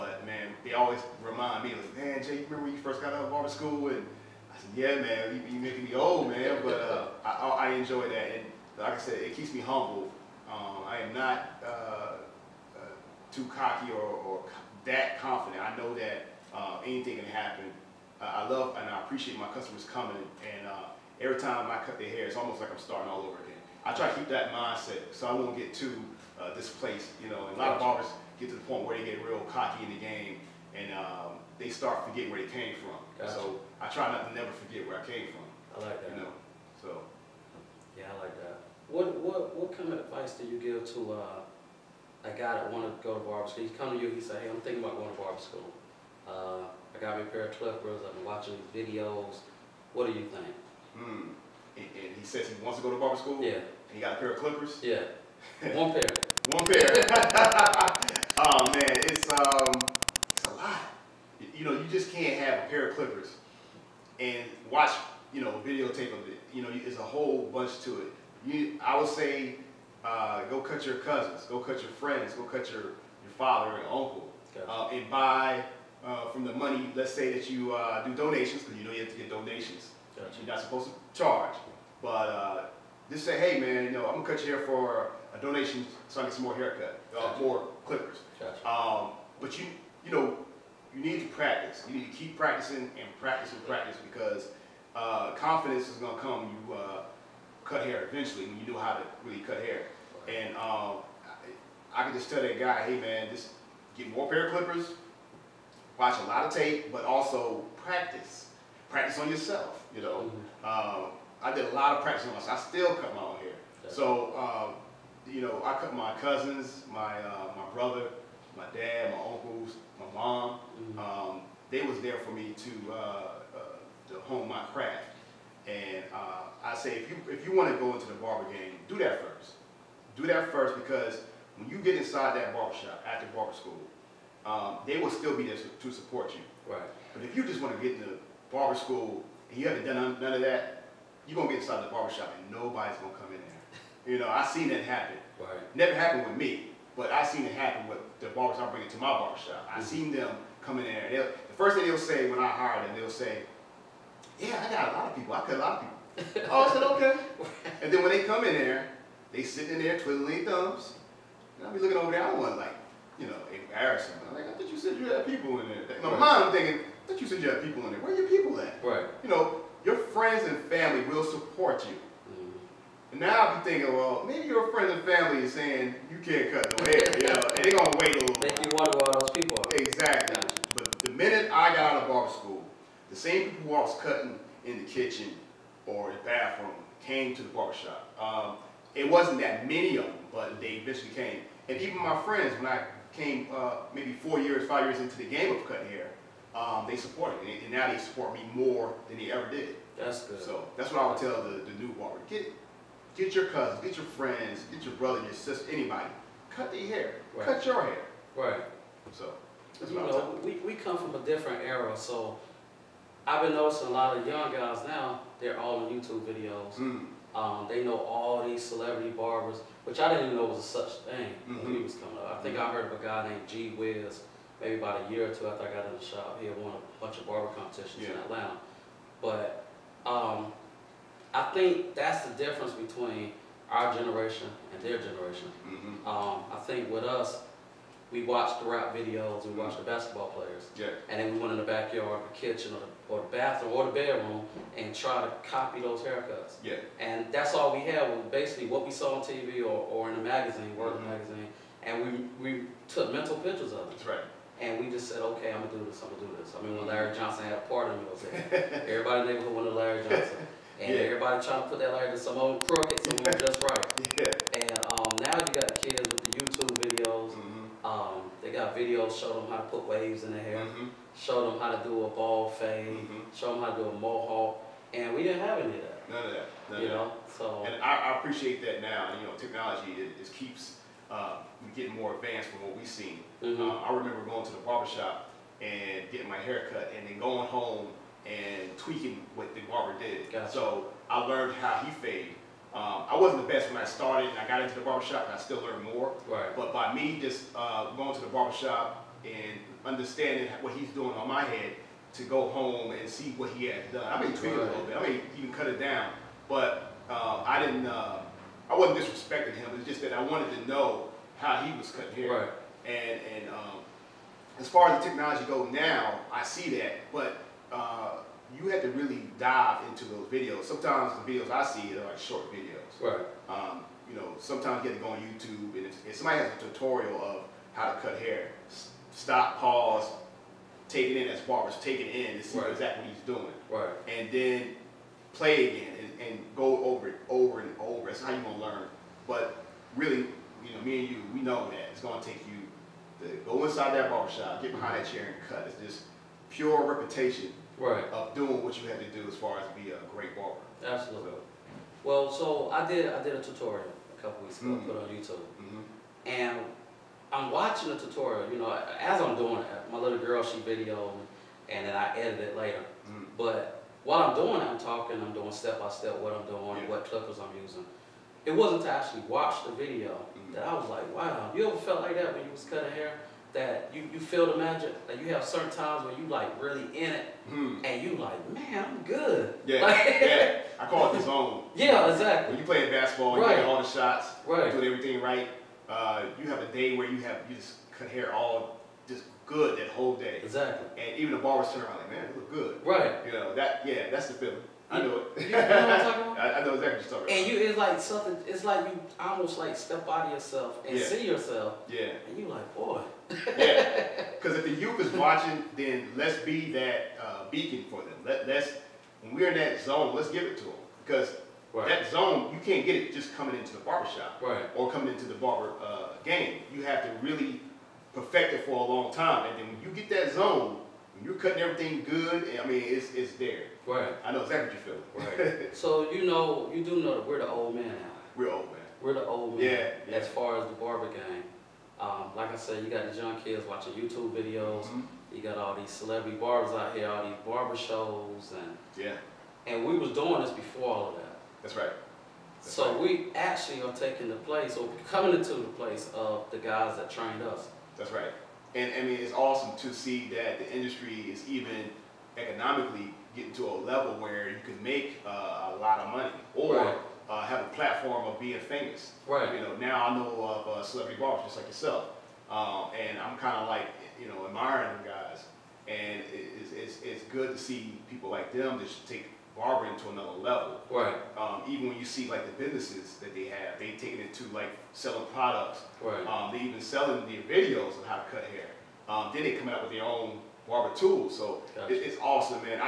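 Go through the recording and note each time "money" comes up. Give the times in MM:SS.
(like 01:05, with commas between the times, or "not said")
01:16, 07:36.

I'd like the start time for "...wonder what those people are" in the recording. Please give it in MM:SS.
02:58.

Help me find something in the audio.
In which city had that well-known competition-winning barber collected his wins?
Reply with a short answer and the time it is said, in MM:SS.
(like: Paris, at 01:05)
Atlanta, at 03:48.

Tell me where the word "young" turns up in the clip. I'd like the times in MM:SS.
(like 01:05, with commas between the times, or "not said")
03:34, 07:13.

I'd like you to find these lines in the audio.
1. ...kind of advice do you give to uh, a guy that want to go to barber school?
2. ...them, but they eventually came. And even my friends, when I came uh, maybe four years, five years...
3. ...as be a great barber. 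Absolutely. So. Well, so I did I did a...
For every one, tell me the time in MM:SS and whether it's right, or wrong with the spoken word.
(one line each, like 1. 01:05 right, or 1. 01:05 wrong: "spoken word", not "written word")
1. 00:39 right
2. 03:10 right
3. 05:49 right.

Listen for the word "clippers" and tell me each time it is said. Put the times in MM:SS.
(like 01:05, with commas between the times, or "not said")
00:47, 00:54, 01:02, 01:27, 01:44, 06:07.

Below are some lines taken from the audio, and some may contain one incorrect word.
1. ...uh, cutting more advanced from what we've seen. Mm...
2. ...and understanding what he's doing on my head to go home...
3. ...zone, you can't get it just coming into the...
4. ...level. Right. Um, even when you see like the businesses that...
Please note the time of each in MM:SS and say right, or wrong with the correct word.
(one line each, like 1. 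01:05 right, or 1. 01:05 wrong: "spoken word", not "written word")
1. 04:41 wrong: "getting", not "cutting"
2. 04:59 right
3. 06:52 right
4. 07:50 right.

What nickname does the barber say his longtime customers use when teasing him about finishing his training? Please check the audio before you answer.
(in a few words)
Jay.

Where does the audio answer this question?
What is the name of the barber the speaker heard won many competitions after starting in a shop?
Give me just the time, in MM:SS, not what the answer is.
03:43.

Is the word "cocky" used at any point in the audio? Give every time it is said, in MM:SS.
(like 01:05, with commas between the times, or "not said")
00:13, 00:29.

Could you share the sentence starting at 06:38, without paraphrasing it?
It's like you almost like step out of yourself and yeah.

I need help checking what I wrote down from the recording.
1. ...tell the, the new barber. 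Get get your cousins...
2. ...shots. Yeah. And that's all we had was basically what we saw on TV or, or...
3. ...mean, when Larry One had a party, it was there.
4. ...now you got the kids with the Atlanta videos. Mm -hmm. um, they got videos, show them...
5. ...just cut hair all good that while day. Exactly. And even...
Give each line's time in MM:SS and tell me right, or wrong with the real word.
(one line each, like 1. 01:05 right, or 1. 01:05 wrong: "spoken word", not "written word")
1. 03:21 right
2. 04:06 wrong: "haircuts", not "shots"
3. 04:16 wrong: "Johnson", not "One"
4. 04:25 wrong: "YouTube", not "Atlanta"
5. 06:27 wrong: "whole", not "while".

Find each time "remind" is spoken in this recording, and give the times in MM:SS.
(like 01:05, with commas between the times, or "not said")
00:01.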